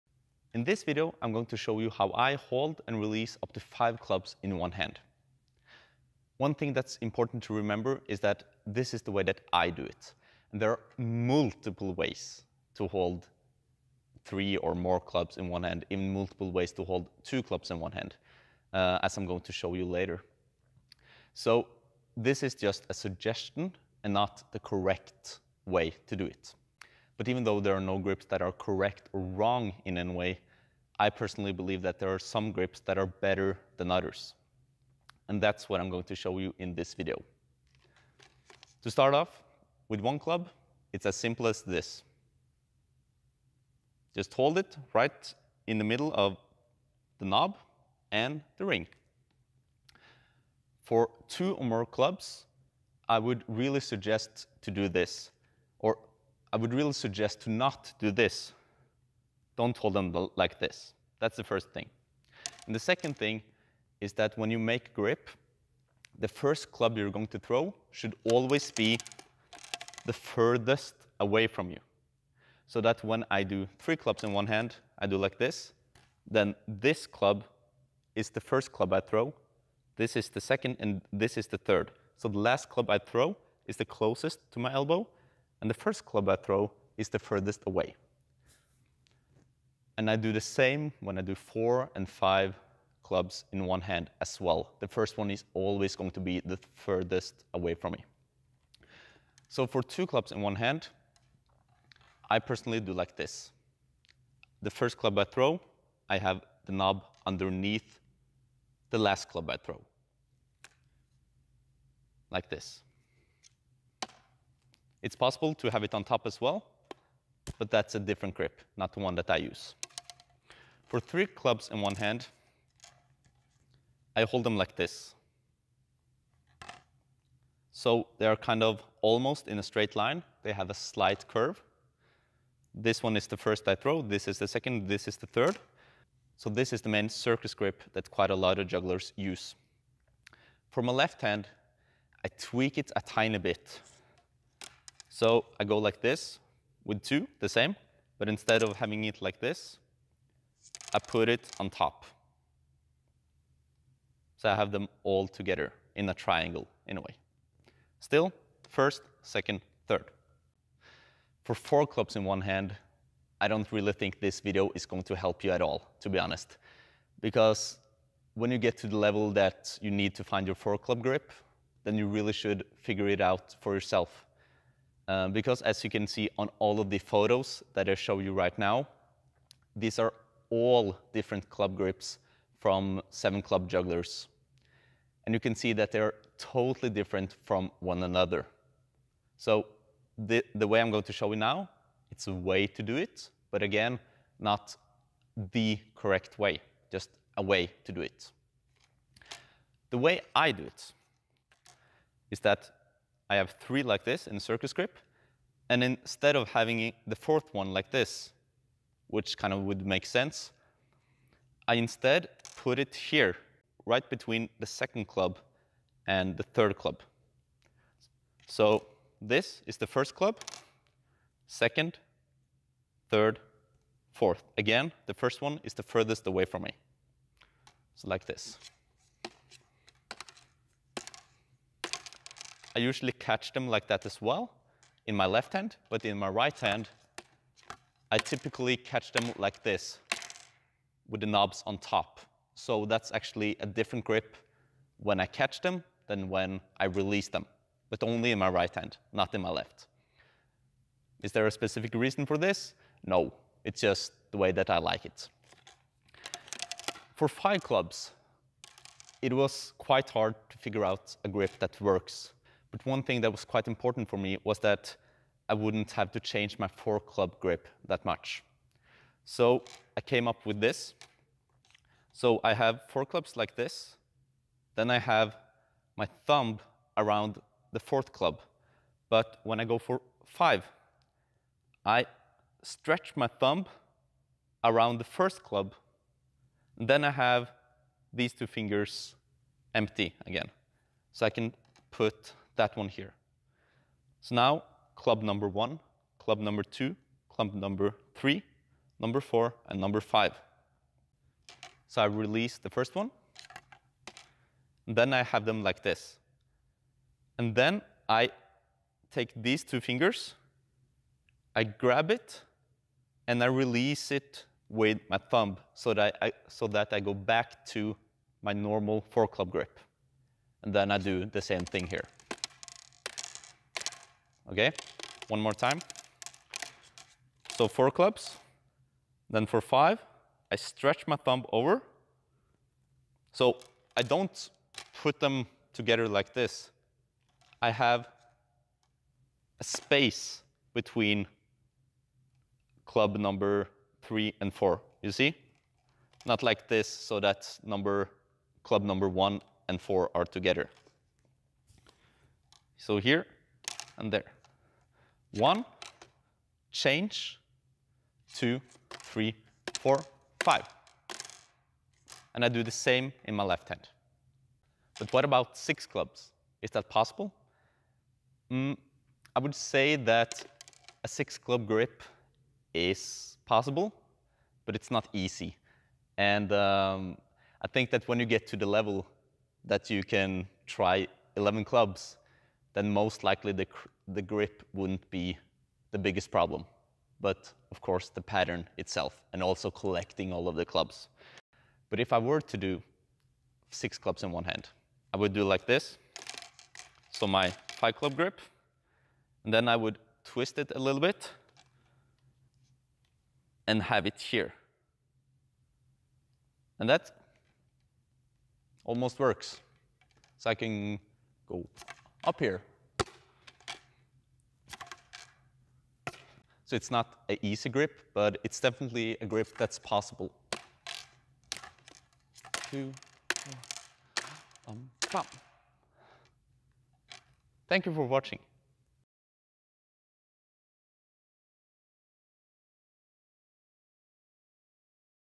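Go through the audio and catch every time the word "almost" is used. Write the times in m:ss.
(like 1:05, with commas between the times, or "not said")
2:09, 6:48.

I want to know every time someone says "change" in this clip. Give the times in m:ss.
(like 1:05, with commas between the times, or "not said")
4:26, 5:56.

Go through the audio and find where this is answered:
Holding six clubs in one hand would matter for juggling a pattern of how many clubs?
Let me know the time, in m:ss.
6:21.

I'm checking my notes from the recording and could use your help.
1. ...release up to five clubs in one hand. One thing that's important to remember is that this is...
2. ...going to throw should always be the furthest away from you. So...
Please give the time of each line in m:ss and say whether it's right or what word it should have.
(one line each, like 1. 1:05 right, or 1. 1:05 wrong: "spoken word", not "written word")
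1. 0:02 right
2. 1:07 right.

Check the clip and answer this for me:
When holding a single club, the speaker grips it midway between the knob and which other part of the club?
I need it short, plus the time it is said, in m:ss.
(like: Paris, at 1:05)
The ring, at 0:48.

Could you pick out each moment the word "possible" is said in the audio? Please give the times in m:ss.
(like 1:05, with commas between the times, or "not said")
1:55, 6:06, 6:13, 6:59.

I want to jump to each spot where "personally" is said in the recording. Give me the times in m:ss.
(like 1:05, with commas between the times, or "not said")
0:31, 1:42.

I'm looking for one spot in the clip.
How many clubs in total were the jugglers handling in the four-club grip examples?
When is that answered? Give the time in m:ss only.
3:03.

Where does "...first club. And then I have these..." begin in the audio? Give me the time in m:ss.
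4:45.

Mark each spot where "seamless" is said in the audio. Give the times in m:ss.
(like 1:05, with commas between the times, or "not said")
not said.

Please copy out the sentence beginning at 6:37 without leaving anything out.
So my five club grip, and then I would twist it a little bit and have it here.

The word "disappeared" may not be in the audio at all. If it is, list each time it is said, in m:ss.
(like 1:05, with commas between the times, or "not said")
not said.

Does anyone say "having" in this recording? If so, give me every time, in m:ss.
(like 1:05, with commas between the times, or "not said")
2:28, 3:26.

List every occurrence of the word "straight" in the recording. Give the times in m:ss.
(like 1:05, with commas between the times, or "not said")
2:09.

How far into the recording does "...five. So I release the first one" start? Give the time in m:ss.
5:00.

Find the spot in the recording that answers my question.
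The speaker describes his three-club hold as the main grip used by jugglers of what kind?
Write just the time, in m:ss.
2:17.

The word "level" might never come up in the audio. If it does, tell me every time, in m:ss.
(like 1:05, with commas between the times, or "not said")
2:48, 6:18.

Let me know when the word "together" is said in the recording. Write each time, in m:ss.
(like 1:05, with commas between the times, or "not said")
2:35, 5:35, 5:50.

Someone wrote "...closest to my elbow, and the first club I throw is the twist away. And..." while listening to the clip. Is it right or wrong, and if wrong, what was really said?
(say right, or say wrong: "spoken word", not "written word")
wrong: "furthest", not "twist".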